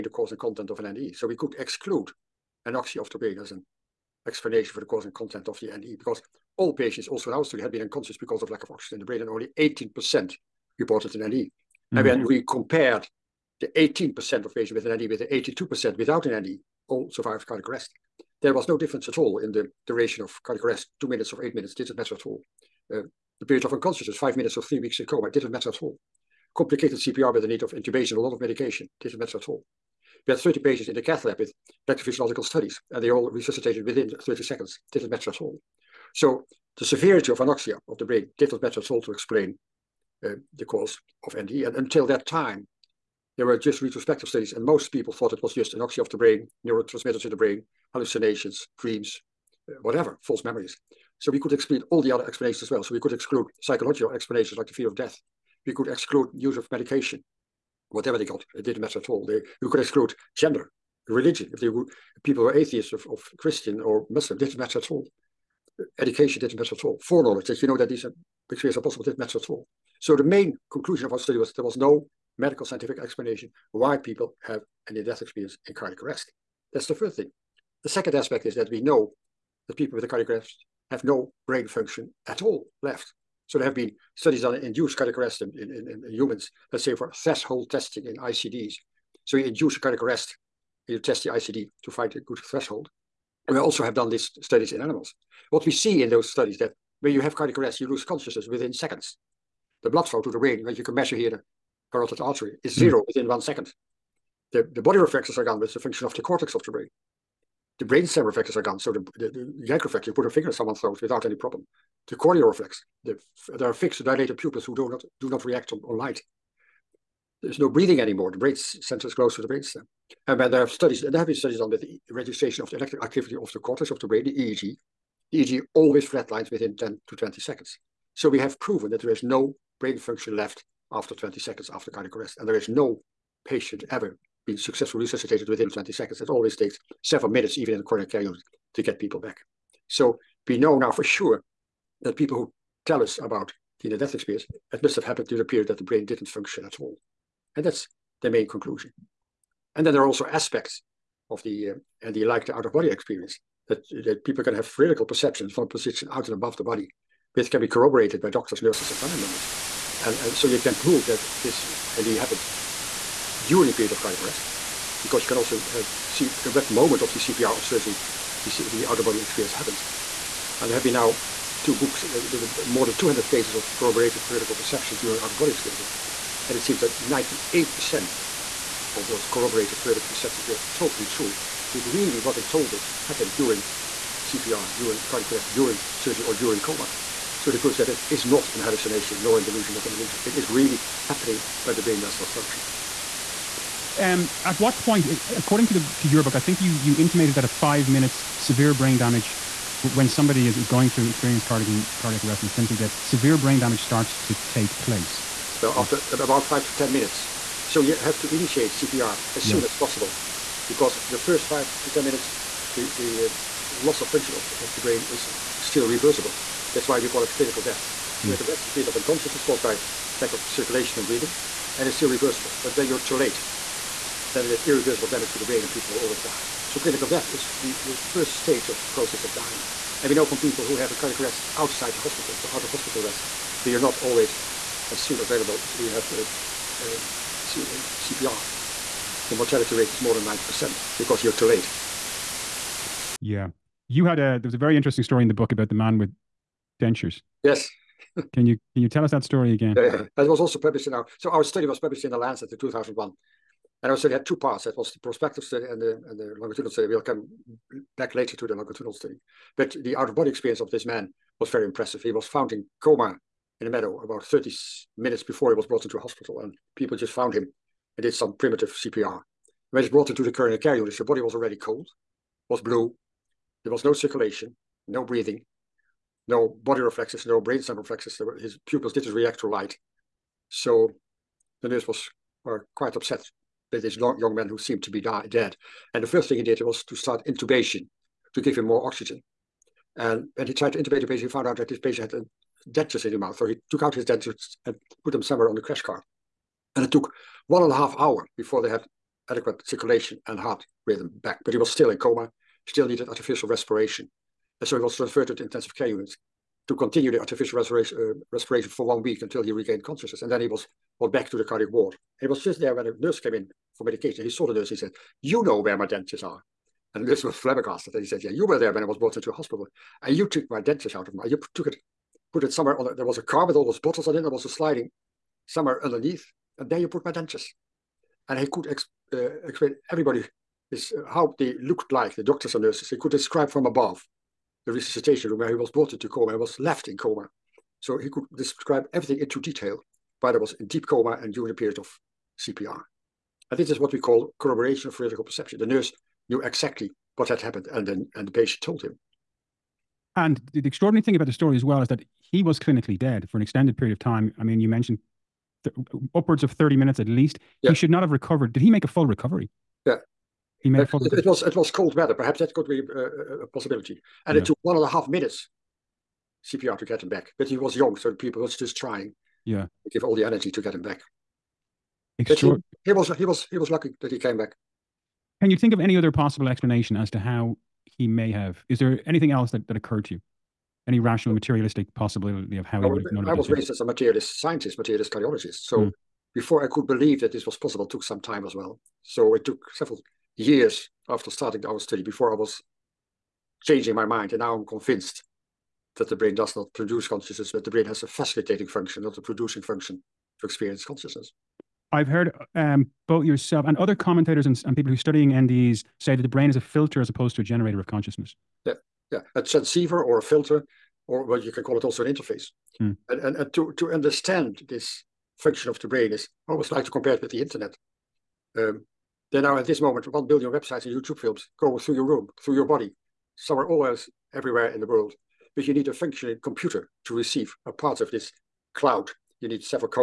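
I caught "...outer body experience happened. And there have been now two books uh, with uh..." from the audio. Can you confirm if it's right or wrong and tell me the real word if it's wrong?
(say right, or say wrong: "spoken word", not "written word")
right.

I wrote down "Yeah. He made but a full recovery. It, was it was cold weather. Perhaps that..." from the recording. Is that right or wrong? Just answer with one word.
right.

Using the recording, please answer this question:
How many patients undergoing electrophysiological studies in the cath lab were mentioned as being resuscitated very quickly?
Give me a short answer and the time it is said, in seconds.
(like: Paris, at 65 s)
30, at 30 s.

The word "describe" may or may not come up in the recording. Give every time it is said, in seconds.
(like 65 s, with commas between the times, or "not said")
333 s, 338 s.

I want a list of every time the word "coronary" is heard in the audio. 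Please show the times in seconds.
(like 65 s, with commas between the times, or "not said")
137 s, 270 s.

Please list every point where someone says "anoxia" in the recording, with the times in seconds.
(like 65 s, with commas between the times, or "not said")
2 s, 37 s, 45 s.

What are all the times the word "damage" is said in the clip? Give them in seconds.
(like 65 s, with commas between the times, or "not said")
198 s, 203 s, 225 s.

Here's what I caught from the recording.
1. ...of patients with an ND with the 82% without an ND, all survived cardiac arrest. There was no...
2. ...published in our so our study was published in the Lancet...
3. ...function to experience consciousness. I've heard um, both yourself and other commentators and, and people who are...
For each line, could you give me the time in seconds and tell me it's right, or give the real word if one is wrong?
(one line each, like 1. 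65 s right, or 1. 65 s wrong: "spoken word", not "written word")
1. 14 s right
2. 250 s right
3. 399 s right.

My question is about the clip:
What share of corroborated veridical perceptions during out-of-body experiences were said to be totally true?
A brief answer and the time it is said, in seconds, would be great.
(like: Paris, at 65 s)
98%, at 176 s.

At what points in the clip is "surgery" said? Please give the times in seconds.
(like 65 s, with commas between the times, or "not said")
167 s, 185 s.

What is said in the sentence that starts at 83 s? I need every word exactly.
So there have been studies on induced cardiac arrest in, in, in, in humans, let's say for threshold testing in ICDs.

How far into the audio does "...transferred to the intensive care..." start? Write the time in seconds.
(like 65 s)
304 s.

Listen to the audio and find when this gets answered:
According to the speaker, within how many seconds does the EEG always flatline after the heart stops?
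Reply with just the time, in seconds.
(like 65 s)
126 s.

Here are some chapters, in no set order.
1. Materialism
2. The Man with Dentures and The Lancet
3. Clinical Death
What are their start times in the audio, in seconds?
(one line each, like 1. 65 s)
1. 379 s
2. 244 s
3. 201 s.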